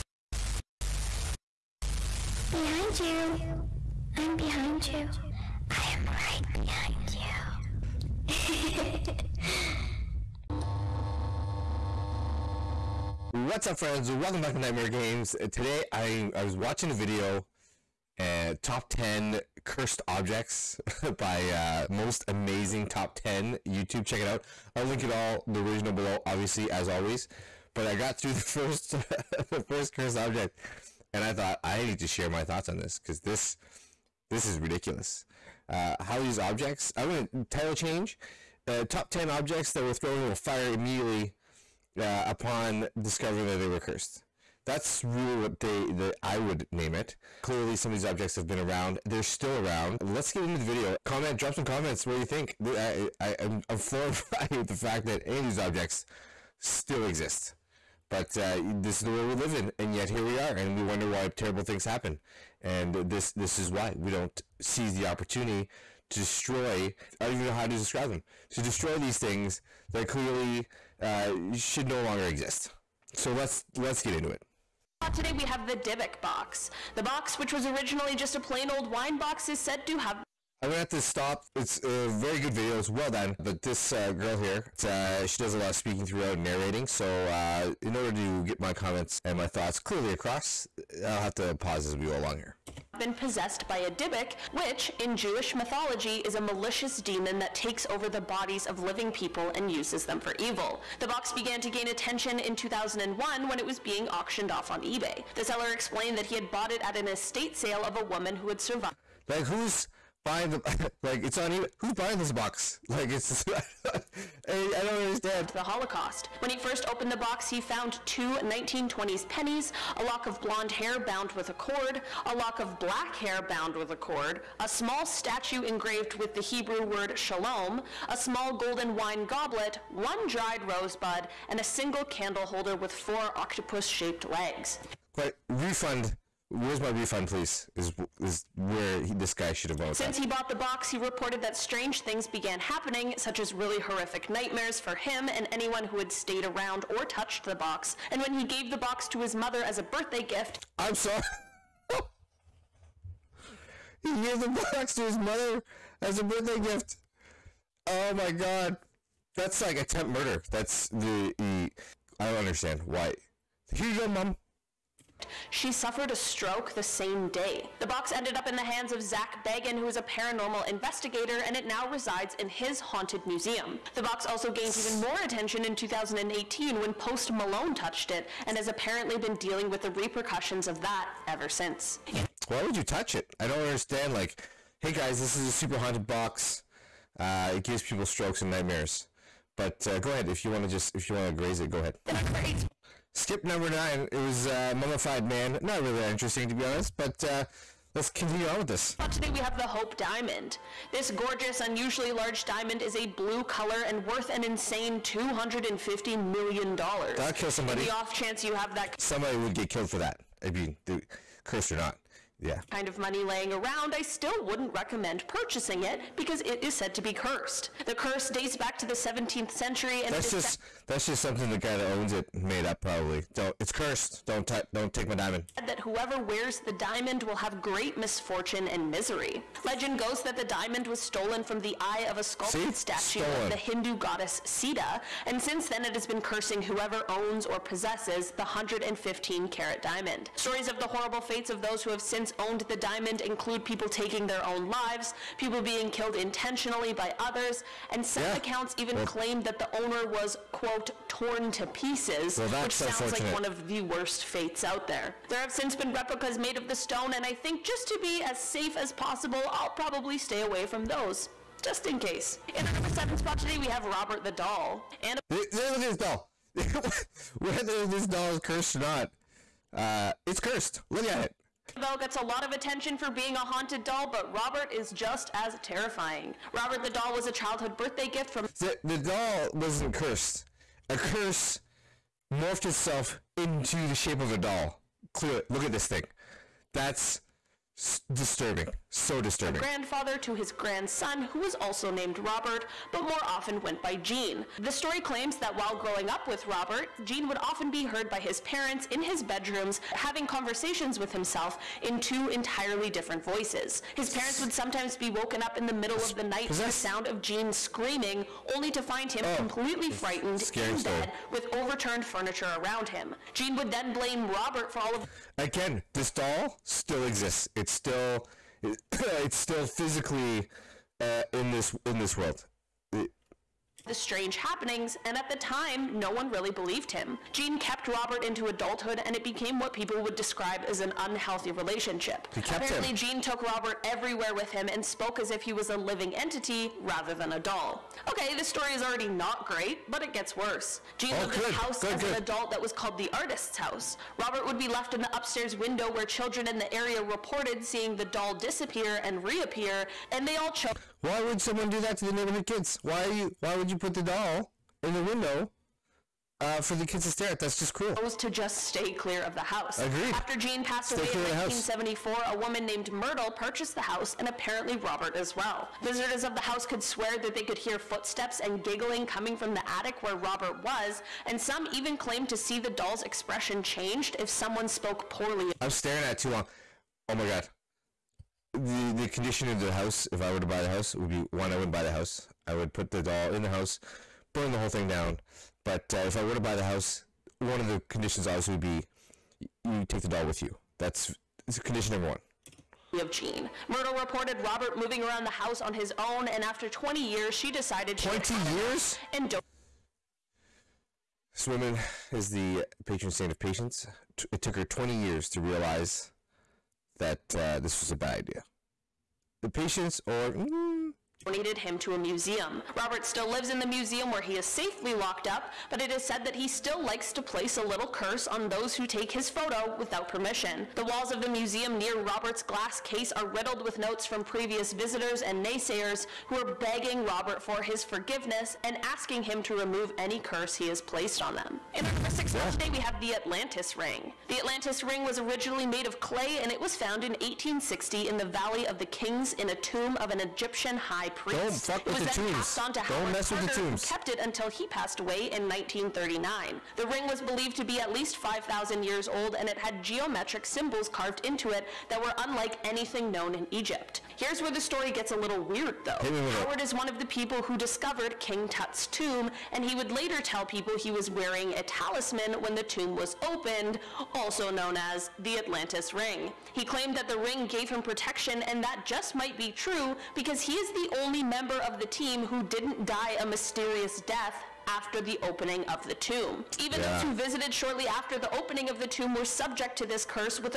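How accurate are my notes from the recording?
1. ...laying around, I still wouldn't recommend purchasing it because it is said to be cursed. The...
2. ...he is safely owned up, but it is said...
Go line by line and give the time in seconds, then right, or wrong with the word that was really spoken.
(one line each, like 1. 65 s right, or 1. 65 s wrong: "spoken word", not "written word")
1. 213 s right
2. 414 s wrong: "locked", not "owned".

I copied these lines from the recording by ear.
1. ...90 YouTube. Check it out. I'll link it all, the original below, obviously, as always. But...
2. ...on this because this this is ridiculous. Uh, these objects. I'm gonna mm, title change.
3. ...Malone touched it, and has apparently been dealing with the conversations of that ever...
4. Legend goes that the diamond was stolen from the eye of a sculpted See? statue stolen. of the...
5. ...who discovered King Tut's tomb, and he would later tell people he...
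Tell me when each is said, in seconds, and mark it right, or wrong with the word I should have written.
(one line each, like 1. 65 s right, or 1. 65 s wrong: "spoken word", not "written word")
1. 23 s wrong: "10", not "90"
2. 32 s right
3. 177 s wrong: "repercussions", not "conversations"
4. 229 s right
5. 457 s right.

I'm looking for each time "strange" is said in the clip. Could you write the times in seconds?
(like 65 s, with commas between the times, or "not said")
141 s, 323 s.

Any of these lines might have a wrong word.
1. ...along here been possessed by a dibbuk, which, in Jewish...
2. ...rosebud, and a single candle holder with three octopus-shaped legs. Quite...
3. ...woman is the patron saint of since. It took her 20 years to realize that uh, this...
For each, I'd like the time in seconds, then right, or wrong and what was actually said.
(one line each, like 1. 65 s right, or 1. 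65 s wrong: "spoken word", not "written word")
1. 92 s right
2. 130 s wrong: "four", not "three"
3. 401 s wrong: "patience", not "since".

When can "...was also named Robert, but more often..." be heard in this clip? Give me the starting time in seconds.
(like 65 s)
291 s.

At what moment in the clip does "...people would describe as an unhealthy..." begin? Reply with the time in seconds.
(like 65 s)
329 s.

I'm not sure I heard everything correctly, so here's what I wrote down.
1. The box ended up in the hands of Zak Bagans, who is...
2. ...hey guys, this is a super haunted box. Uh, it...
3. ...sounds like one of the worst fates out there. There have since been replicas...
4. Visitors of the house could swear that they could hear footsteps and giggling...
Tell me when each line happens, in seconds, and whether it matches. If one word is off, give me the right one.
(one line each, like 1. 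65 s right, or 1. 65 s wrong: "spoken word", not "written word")
1. 167 s right
2. 184 s right
3. 252 s right
4. 365 s right.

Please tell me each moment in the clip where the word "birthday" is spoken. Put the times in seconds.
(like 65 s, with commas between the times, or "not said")
149 s, 156 s, 277 s.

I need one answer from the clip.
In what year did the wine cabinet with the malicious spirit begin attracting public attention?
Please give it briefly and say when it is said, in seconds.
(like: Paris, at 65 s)
2001, at 102 s.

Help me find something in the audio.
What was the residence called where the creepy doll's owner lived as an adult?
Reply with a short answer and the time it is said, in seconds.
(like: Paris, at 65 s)
the artist's house, at 343 s.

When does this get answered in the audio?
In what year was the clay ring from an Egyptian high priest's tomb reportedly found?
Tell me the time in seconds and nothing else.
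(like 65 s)
437 s.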